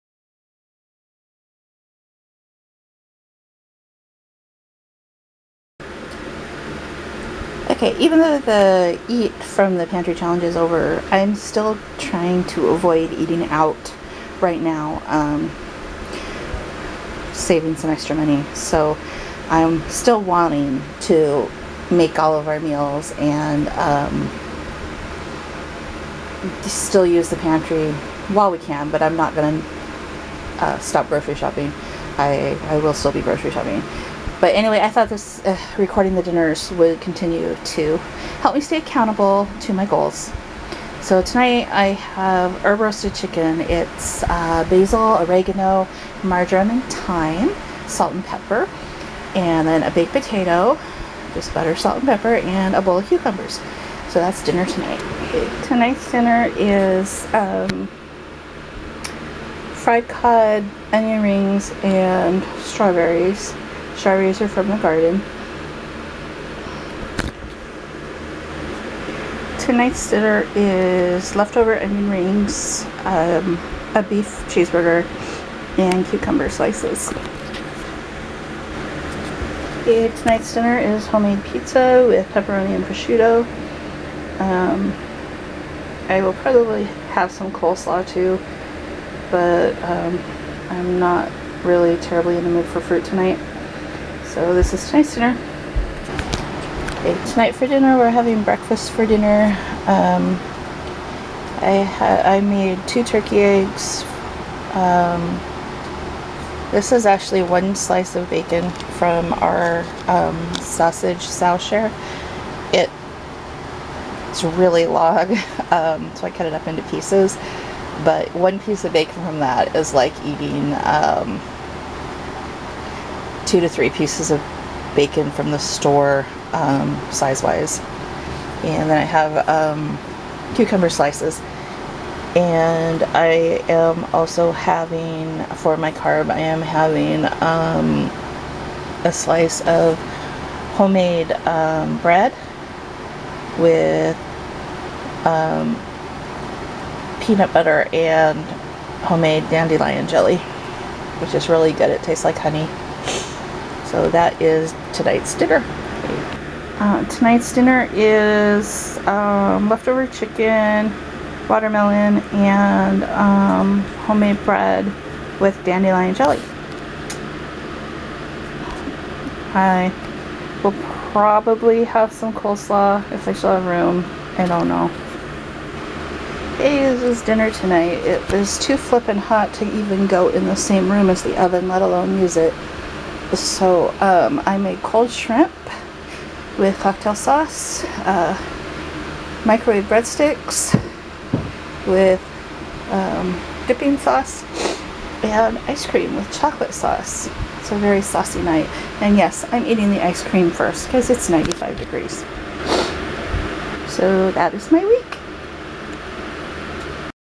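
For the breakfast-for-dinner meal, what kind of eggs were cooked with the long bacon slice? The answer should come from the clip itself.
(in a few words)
turkey eggs.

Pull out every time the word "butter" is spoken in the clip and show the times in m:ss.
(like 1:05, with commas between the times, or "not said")
0:51, 2:27.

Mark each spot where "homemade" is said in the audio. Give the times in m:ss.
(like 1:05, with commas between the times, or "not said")
1:21, 2:20, 2:29, 2:44.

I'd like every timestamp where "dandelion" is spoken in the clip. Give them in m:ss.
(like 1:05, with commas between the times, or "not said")
2:29, 2:45.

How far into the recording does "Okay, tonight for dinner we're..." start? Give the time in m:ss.
1:36.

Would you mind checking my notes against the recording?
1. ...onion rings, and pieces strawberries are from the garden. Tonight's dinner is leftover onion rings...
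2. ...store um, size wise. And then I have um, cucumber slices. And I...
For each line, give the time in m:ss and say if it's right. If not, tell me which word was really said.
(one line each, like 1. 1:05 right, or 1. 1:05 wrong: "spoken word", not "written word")
1. 1:00 wrong: "strawberries", not "pieces"
2. 2:05 right.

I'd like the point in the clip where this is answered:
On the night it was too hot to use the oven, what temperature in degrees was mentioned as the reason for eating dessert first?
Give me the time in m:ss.
3:21.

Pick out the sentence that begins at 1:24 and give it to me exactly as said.
Um, I will probably have some coleslaw too, but um, I'm not really terribly in the mood for fruit tonight.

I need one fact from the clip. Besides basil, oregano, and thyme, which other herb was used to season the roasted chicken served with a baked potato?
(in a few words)
marjoram.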